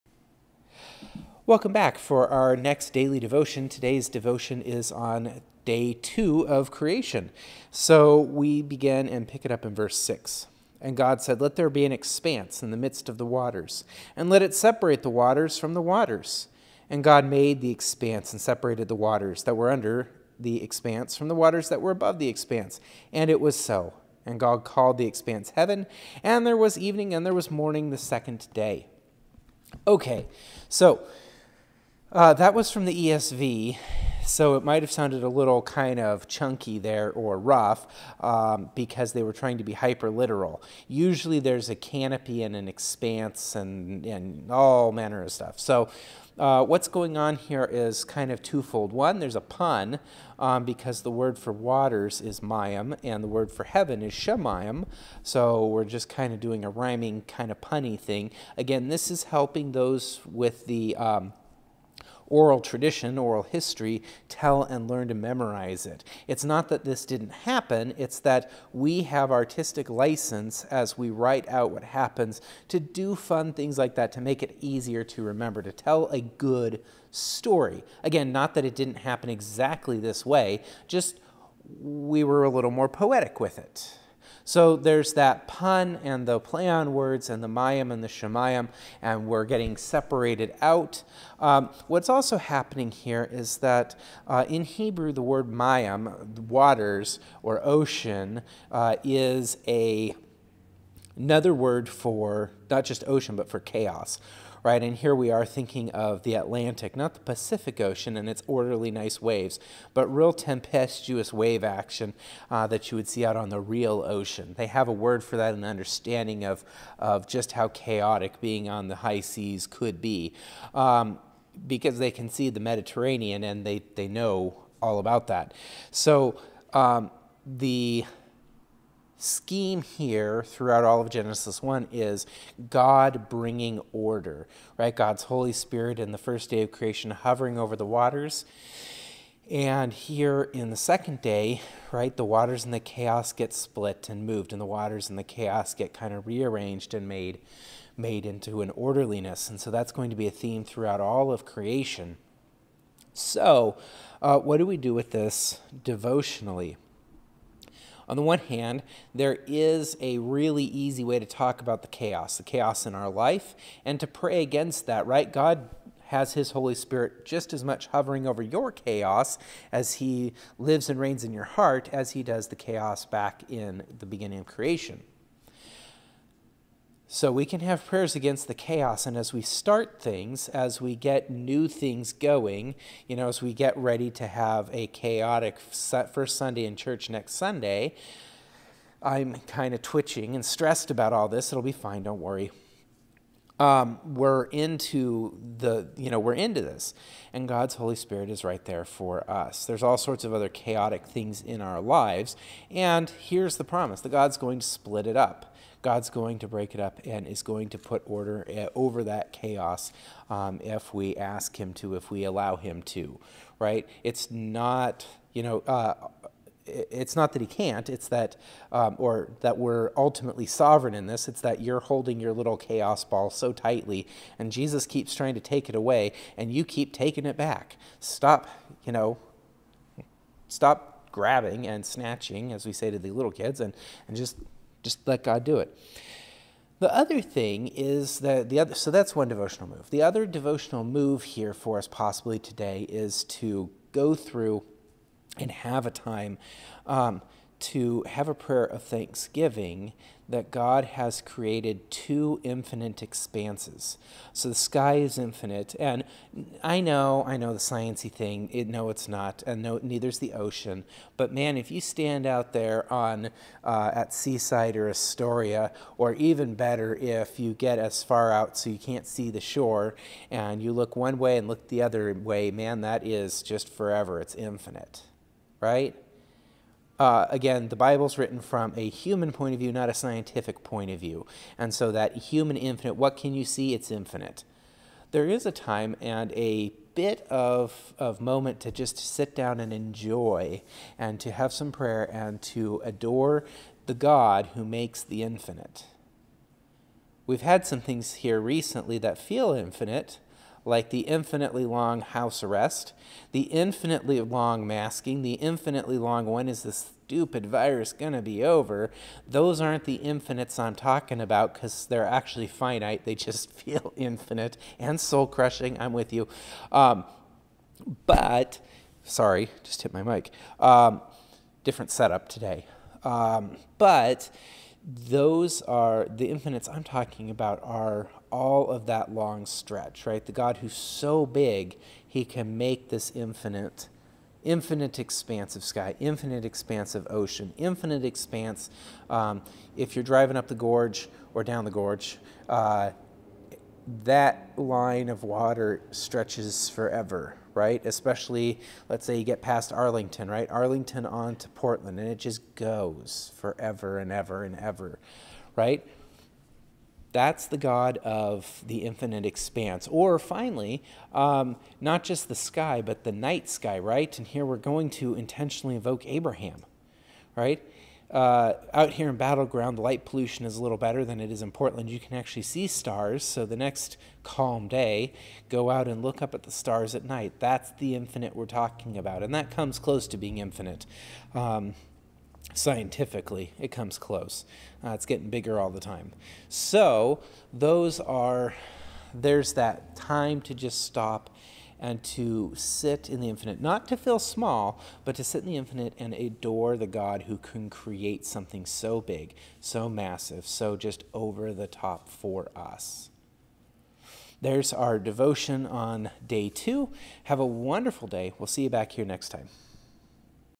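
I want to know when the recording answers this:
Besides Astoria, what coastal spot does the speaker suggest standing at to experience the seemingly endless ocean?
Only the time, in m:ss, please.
4:24.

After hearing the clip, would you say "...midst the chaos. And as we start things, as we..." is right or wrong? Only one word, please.
wrong.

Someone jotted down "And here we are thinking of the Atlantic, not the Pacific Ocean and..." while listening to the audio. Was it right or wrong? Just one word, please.
right.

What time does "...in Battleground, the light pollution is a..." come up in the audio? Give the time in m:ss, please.
6:09.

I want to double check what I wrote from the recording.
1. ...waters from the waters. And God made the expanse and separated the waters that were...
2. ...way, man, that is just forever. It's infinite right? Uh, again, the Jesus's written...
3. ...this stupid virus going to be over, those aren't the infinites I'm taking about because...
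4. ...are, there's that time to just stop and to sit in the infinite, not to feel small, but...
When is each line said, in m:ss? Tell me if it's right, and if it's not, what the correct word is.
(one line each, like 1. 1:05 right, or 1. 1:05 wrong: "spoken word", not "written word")
1. 0:15 right
2. 4:32 wrong: "Bible", not "Jesus"
3. 5:06 wrong: "talking", not "taking"
4. 6:28 right.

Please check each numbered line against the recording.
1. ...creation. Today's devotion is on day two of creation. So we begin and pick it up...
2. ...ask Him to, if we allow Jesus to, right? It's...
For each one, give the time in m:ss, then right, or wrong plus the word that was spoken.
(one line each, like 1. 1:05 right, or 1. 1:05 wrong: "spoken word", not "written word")
1. 0:03 wrong: "devotion", not "creation"
2. 3:31 wrong: "Him", not "Jesus".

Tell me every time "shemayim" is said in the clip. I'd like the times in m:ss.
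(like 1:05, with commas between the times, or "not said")
0:54, 1:28.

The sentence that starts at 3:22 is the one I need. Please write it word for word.
And here's the promise that God's going to split it up.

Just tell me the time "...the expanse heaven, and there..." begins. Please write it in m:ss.
0:24.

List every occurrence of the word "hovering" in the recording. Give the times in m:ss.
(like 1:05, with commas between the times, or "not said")
2:17, 2:47.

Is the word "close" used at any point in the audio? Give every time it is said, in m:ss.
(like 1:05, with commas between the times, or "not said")
6:19, 6:23.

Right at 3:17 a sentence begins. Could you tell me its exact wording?
And God's Holy Spirit is right there for us.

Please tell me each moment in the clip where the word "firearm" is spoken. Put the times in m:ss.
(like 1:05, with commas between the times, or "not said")
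not said.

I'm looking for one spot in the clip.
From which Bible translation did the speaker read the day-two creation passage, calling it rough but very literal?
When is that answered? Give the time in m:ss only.
0:33.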